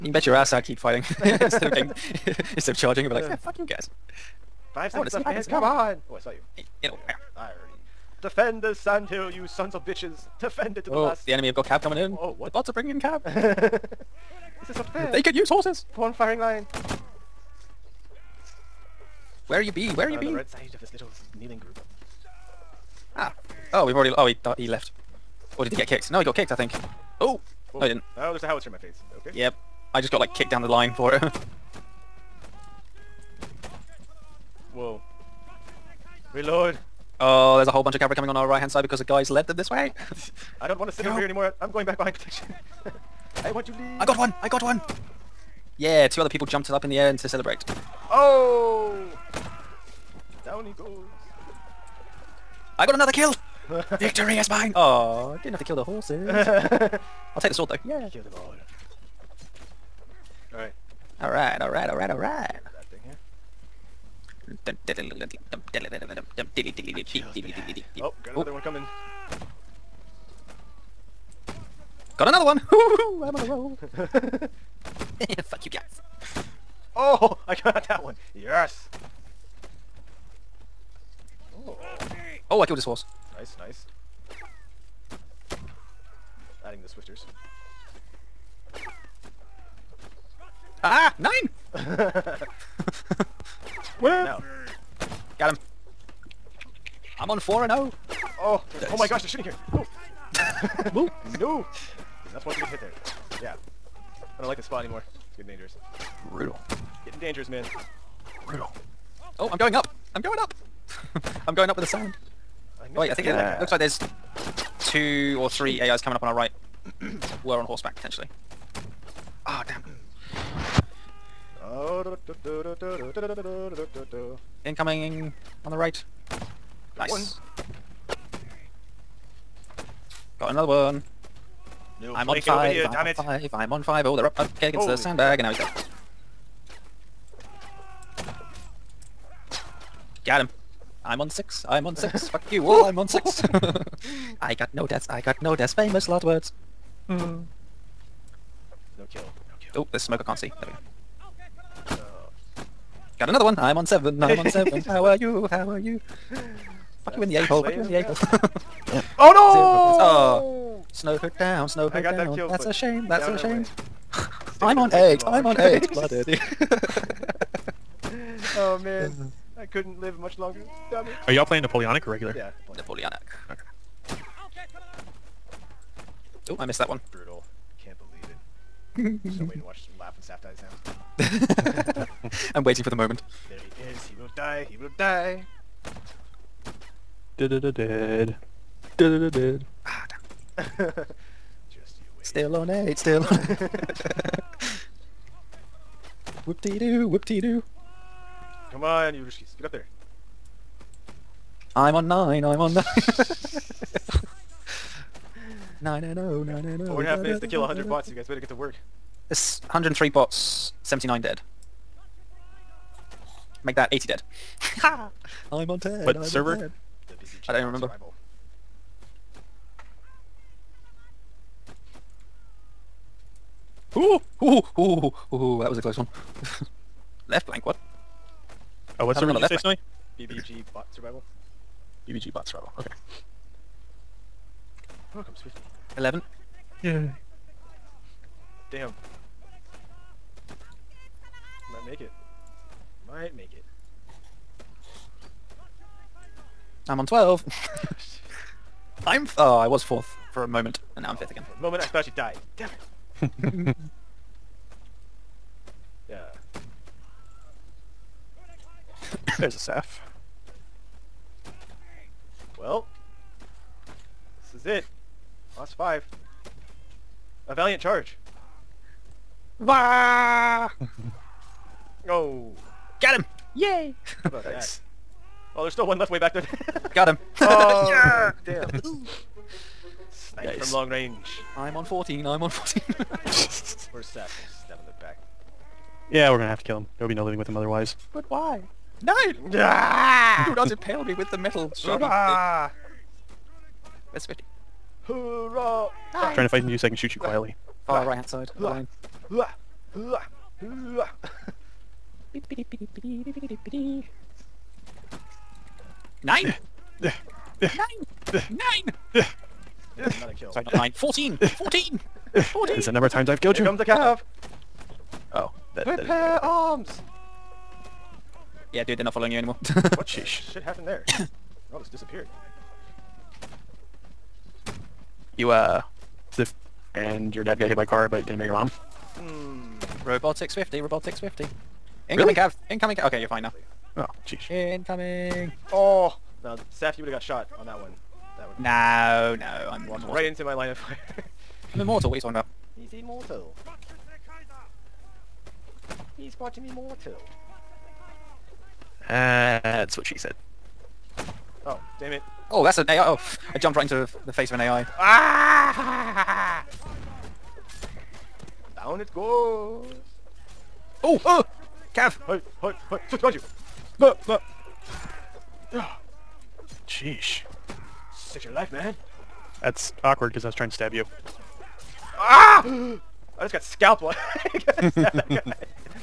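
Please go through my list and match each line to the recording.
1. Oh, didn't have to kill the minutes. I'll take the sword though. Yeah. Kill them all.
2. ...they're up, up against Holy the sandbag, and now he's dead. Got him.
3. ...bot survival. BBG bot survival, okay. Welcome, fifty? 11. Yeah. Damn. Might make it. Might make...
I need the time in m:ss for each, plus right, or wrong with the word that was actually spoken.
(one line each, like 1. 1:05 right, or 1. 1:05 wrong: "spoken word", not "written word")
1. 0:54 wrong: "horses", not "minutes"
2. 2:14 right
3. 3:50 right.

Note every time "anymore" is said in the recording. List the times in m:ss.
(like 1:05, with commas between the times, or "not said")
0:41, 1:44, 5:19.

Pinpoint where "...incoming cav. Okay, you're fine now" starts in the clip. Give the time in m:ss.
5:32.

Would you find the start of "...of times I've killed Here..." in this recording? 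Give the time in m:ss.
5:13.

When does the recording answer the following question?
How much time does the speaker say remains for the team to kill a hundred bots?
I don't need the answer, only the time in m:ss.
3:26.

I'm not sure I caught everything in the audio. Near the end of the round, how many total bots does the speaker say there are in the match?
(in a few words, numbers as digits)
103.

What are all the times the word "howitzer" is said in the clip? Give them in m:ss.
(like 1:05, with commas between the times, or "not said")
0:28.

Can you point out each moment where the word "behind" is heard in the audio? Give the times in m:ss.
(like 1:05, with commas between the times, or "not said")
0:41, 6:03.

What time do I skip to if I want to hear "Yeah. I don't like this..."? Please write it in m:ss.
1:43.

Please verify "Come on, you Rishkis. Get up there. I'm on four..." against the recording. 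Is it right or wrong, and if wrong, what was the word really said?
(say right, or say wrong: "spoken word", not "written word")
wrong: "nine", not "four".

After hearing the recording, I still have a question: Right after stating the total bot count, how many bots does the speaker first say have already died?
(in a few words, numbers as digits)
79.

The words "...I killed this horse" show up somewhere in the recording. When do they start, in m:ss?
1:22.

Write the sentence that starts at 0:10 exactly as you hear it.
Defend it to the oh, last.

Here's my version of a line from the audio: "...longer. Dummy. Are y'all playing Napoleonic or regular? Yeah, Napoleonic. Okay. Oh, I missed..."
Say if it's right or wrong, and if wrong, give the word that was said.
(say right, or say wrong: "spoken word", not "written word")
right.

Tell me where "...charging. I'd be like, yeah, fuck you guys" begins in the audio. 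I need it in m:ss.
0:02.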